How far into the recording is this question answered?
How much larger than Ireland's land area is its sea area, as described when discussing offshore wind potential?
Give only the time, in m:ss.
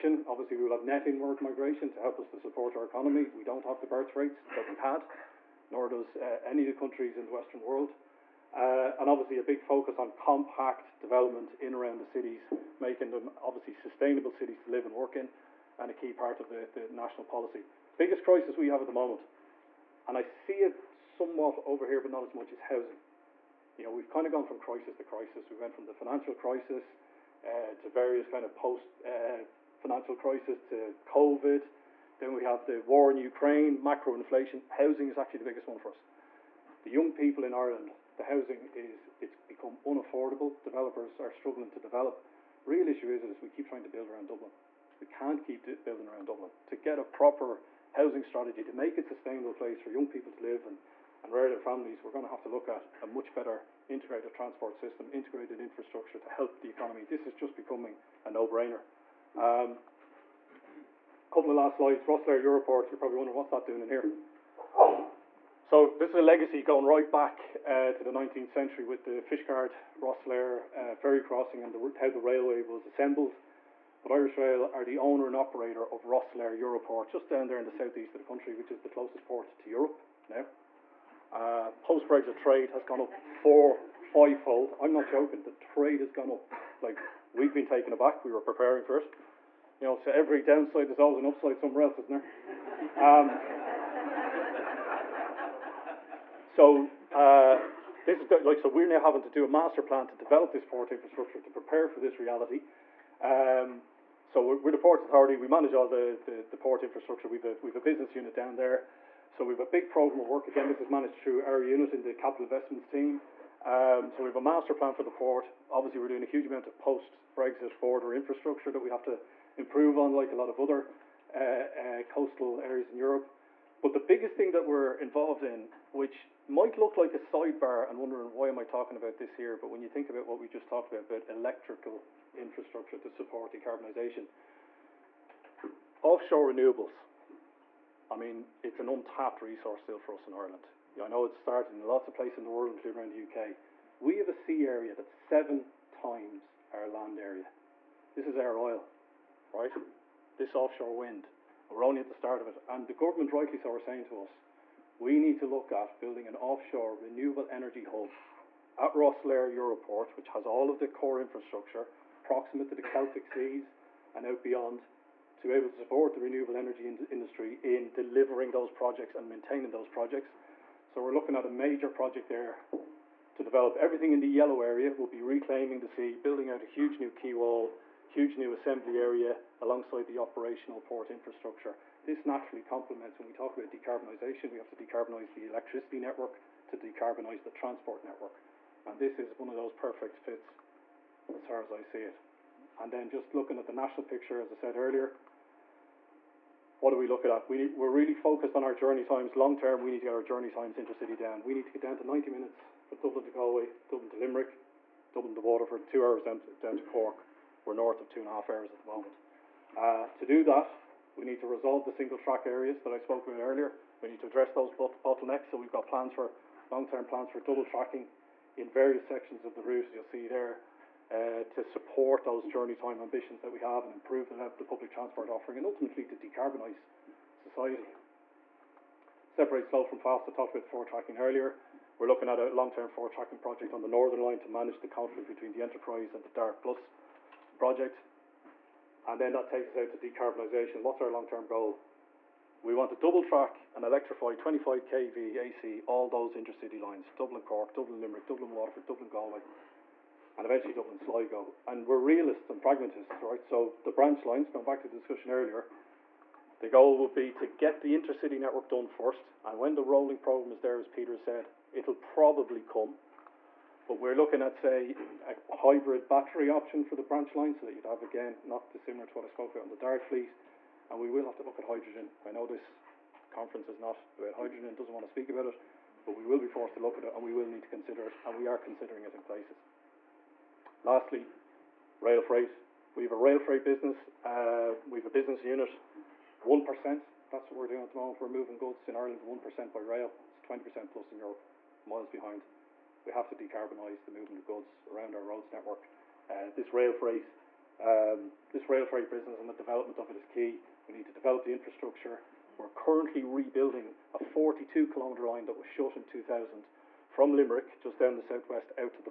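2:25.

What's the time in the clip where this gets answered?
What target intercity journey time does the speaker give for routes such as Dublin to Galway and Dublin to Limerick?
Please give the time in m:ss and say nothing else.
3:22.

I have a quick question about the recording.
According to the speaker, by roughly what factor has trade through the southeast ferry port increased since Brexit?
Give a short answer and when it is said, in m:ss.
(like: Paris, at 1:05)
4 to 5 times, at 1:23.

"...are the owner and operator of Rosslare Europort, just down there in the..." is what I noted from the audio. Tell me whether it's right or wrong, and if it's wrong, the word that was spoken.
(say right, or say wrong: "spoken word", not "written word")
right.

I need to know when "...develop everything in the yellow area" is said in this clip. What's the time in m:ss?
2:53.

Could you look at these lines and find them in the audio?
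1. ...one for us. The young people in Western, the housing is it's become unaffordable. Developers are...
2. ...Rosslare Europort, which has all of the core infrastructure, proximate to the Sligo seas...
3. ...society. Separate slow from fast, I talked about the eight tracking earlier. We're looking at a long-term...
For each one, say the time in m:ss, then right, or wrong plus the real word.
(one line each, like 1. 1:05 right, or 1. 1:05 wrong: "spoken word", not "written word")
1. 0:35 wrong: "Ireland", not "Western"
2. 2:38 wrong: "Celtic", not "Sligo"
3. 3:47 wrong: "four", not "eight".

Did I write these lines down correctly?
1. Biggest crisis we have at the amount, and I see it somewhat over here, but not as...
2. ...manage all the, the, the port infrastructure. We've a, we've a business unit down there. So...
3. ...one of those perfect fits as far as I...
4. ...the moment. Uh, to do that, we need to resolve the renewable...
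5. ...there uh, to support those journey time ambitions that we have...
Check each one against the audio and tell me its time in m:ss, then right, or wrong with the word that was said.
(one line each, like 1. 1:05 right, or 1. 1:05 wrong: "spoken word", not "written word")
1. 0:17 wrong: "moment", not "amount"
2. 1:45 right
3. 3:09 right
4. 3:28 wrong: "single", not "renewable"
5. 3:40 right.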